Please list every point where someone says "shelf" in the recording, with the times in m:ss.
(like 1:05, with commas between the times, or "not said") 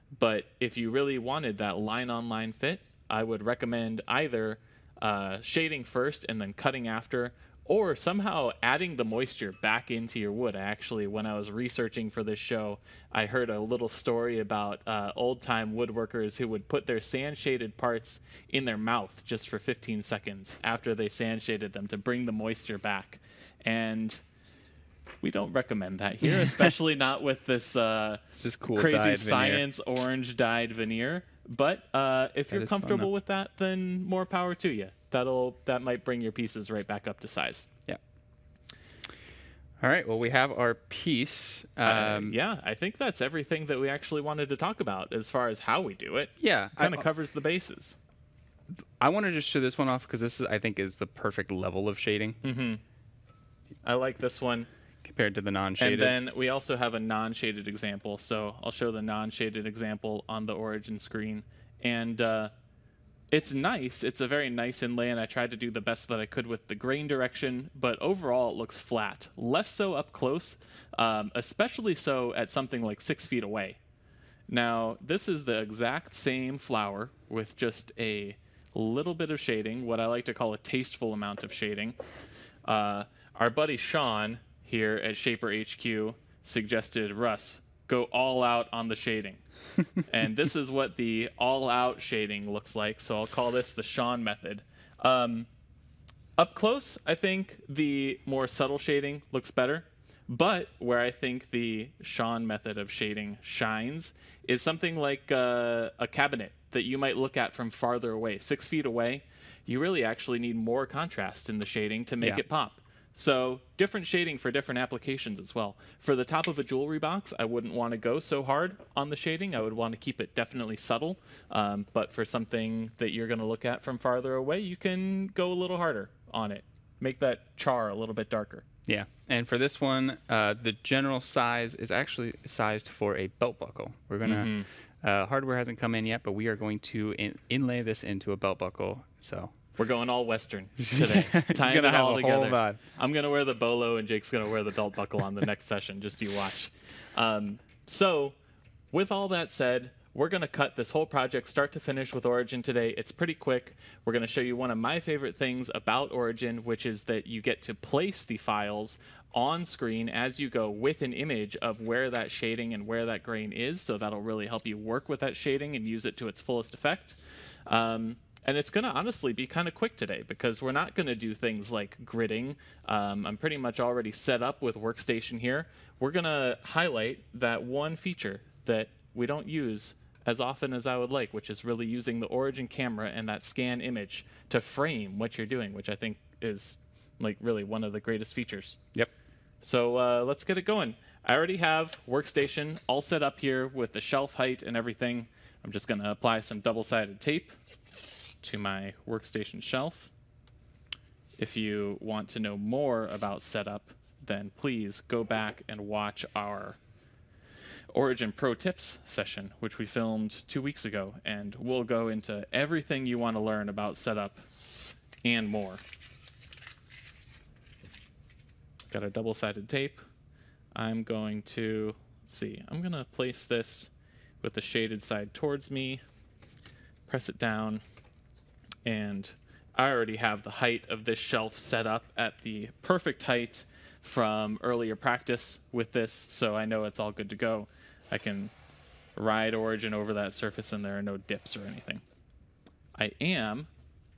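3:14, 3:19, 3:51.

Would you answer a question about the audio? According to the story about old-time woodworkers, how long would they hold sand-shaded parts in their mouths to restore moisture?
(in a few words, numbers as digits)
15 seconds.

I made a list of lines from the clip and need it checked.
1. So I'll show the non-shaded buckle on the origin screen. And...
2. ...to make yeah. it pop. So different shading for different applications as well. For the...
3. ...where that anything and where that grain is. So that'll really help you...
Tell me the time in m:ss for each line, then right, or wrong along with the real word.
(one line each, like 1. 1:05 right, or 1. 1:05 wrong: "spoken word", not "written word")
1. 0:58 wrong: "example", not "buckle"
2. 1:52 right
3. 2:41 wrong: "shading", not "anything".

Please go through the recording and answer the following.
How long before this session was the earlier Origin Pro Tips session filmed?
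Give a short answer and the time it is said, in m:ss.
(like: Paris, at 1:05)
2 weeks, at 3:30.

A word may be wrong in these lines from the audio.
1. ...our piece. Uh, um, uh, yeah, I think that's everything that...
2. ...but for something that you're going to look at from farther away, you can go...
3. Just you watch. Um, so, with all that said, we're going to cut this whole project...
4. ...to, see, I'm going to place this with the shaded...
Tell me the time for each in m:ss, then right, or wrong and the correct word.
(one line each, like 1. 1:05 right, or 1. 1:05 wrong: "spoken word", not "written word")
1. 0:40 right
2. 2:01 right
3. 2:26 right
4. 3:41 right.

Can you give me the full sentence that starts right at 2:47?
Um, and it's going to honestly be kind of quick today because we're not going to do things like gridding.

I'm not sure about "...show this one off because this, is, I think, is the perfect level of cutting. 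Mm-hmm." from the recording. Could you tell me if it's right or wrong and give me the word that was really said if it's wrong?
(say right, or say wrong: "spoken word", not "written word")
wrong: "shading", not "cutting".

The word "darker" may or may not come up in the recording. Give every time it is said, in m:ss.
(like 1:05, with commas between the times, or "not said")
2:08.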